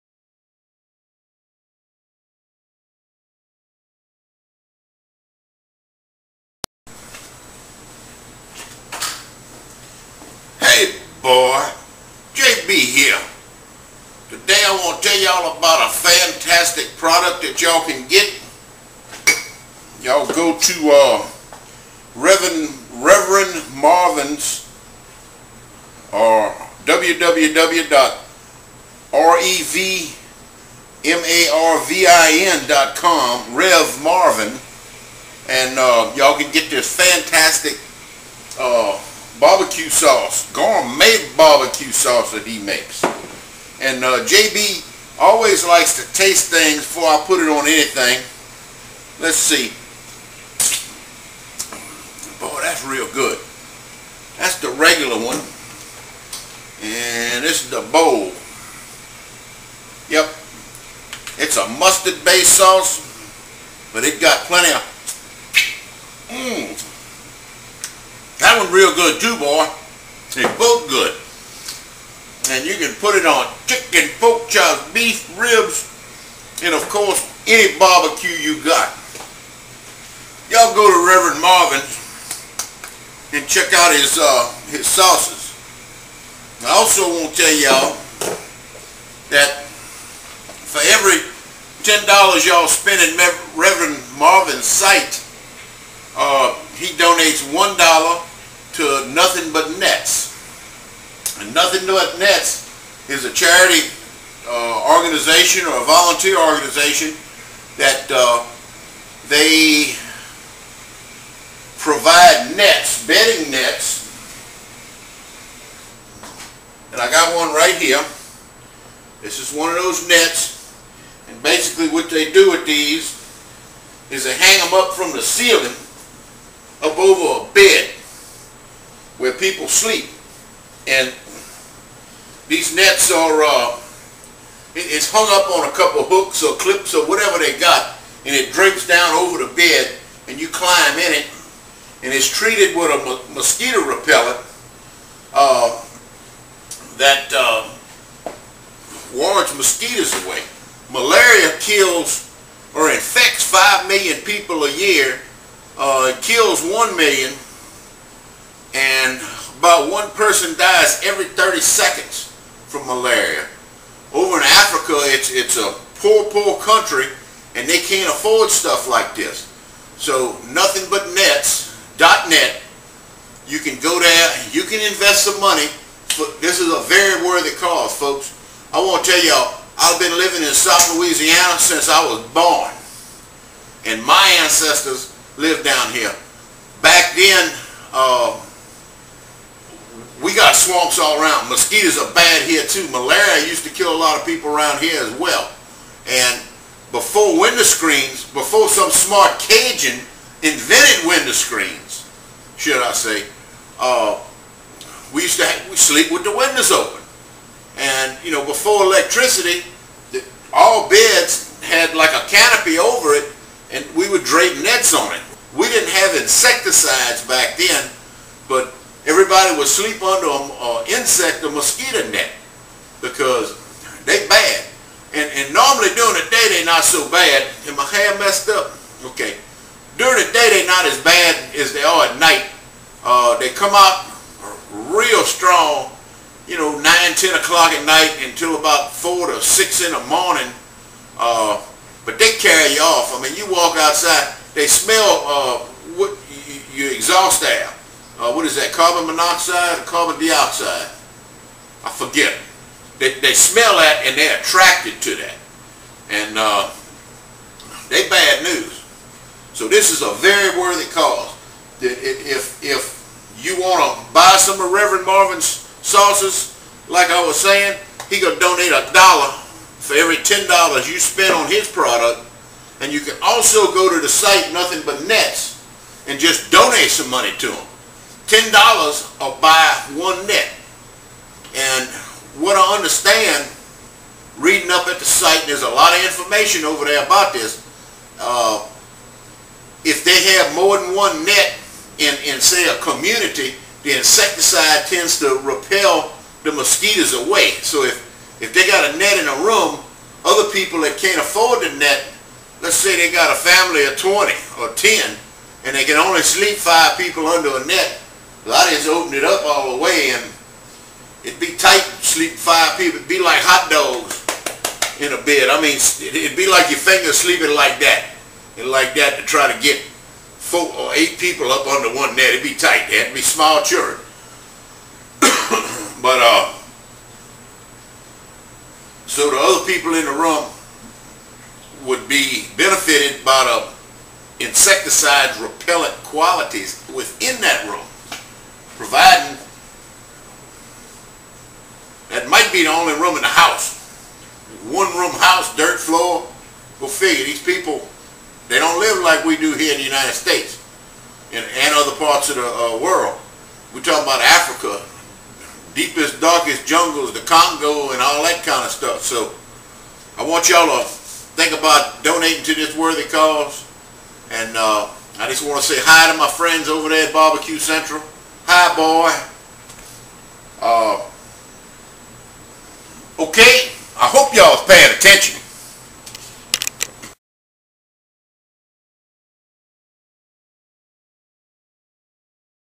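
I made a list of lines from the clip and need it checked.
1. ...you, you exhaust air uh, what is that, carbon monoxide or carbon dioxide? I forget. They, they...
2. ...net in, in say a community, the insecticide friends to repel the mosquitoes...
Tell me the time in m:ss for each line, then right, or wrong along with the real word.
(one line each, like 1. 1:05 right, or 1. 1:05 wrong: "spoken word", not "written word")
1. 4:06 right
2. 4:51 wrong: "tends", not "friends".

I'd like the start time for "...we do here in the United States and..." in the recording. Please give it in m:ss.
5:49.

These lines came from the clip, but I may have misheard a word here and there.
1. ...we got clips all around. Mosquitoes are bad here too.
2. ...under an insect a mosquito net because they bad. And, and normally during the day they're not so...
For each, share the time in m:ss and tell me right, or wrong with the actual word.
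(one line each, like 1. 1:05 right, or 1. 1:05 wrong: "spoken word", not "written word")
1. 3:10 wrong: "swamps", not "clips"
2. 3:40 right.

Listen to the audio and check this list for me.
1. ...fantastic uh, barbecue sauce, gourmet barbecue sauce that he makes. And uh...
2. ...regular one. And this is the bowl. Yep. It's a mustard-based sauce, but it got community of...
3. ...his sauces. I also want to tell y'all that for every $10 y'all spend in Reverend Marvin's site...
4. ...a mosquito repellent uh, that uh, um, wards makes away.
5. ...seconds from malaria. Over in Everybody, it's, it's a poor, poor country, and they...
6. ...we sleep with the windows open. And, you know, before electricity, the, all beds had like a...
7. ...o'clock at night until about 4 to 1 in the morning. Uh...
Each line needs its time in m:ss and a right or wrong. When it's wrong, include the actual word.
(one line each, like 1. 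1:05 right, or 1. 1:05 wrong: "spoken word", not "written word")
1. 0:36 right
2. 0:54 wrong: "plenty", not "community"
3. 1:24 right
4. 2:22 wrong: "mosquitoes", not "makes"
5. 2:41 wrong: "Africa", not "Everybody"
6. 3:25 right
7. 3:57 wrong: "6", not "1".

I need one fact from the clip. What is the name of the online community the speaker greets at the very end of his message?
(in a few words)
Barbecue Central.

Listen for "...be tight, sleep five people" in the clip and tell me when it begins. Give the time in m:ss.
5:11.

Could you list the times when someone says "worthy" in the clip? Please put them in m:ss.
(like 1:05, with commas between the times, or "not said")
2:57, 4:20, 6:02.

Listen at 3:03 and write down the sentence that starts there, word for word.
And my ancestors lived down here.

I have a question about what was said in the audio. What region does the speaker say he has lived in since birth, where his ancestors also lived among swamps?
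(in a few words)
South Louisiana.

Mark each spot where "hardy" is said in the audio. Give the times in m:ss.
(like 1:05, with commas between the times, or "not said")
not said.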